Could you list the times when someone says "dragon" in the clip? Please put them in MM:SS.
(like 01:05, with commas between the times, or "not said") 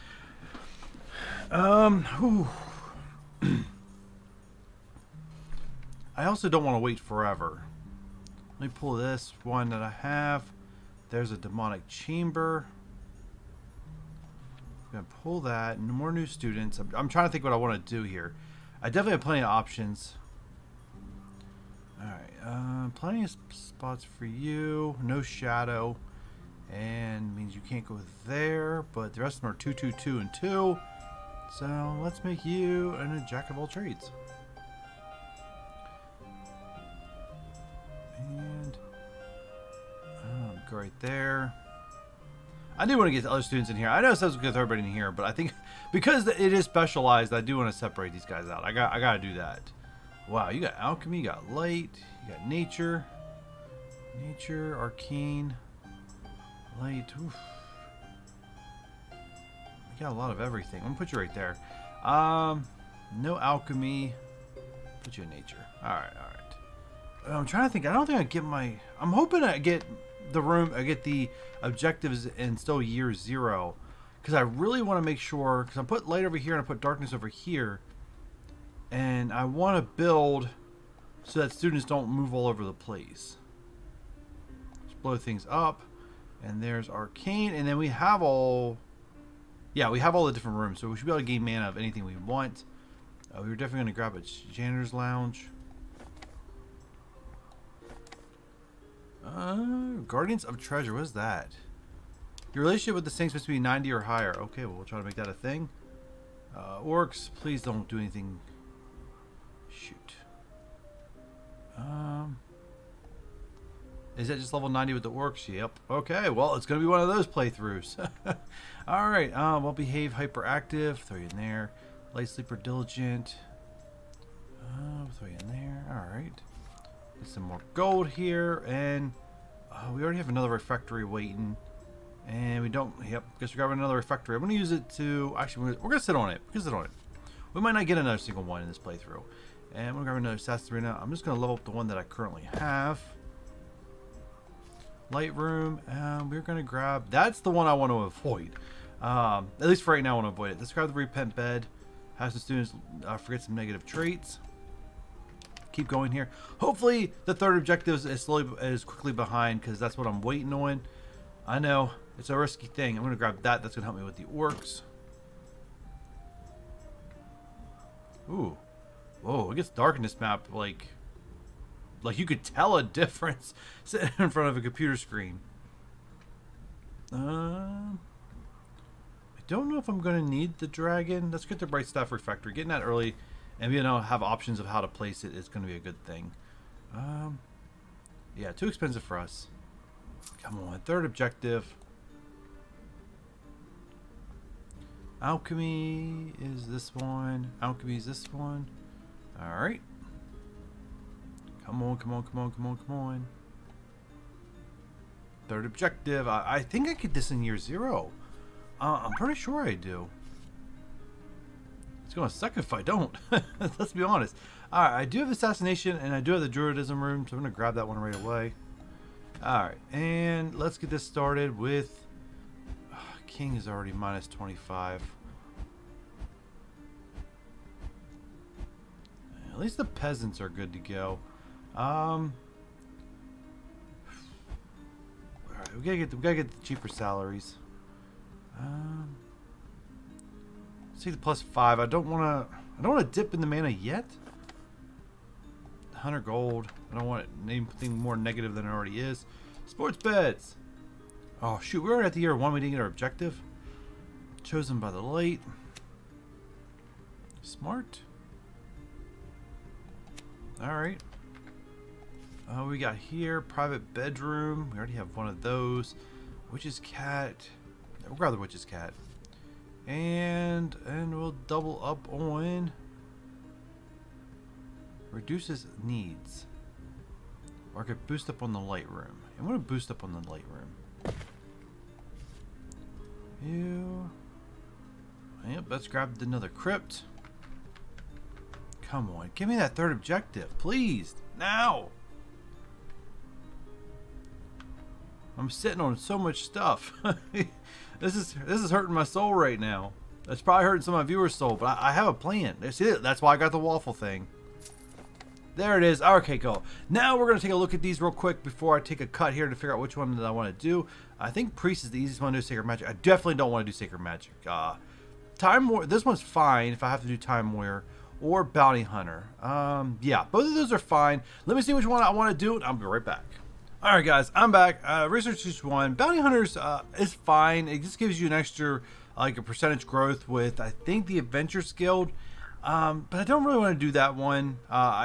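03:00.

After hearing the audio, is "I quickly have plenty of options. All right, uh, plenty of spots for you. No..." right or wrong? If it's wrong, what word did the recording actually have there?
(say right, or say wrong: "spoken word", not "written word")
wrong: "definitely", not "quickly".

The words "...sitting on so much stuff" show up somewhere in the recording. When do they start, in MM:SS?
04:55.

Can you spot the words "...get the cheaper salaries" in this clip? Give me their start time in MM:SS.
03:56.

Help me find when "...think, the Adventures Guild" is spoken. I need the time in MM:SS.
05:30.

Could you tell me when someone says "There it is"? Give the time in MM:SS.
05:05.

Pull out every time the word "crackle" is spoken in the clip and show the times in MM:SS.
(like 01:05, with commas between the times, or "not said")
not said.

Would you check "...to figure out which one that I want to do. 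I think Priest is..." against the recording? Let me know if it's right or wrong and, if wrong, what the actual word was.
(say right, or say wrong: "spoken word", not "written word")
right.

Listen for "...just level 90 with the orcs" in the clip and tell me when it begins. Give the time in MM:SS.
01:54.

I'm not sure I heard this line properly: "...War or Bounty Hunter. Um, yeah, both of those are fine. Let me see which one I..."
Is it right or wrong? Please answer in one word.
right.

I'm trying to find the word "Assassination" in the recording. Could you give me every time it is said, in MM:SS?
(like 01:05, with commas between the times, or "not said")
03:35.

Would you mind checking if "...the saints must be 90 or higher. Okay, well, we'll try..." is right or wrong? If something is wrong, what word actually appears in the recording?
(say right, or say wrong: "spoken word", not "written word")
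right.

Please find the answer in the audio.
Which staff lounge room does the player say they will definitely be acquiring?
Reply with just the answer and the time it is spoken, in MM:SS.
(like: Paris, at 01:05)
janitor's lounge, at 01:34.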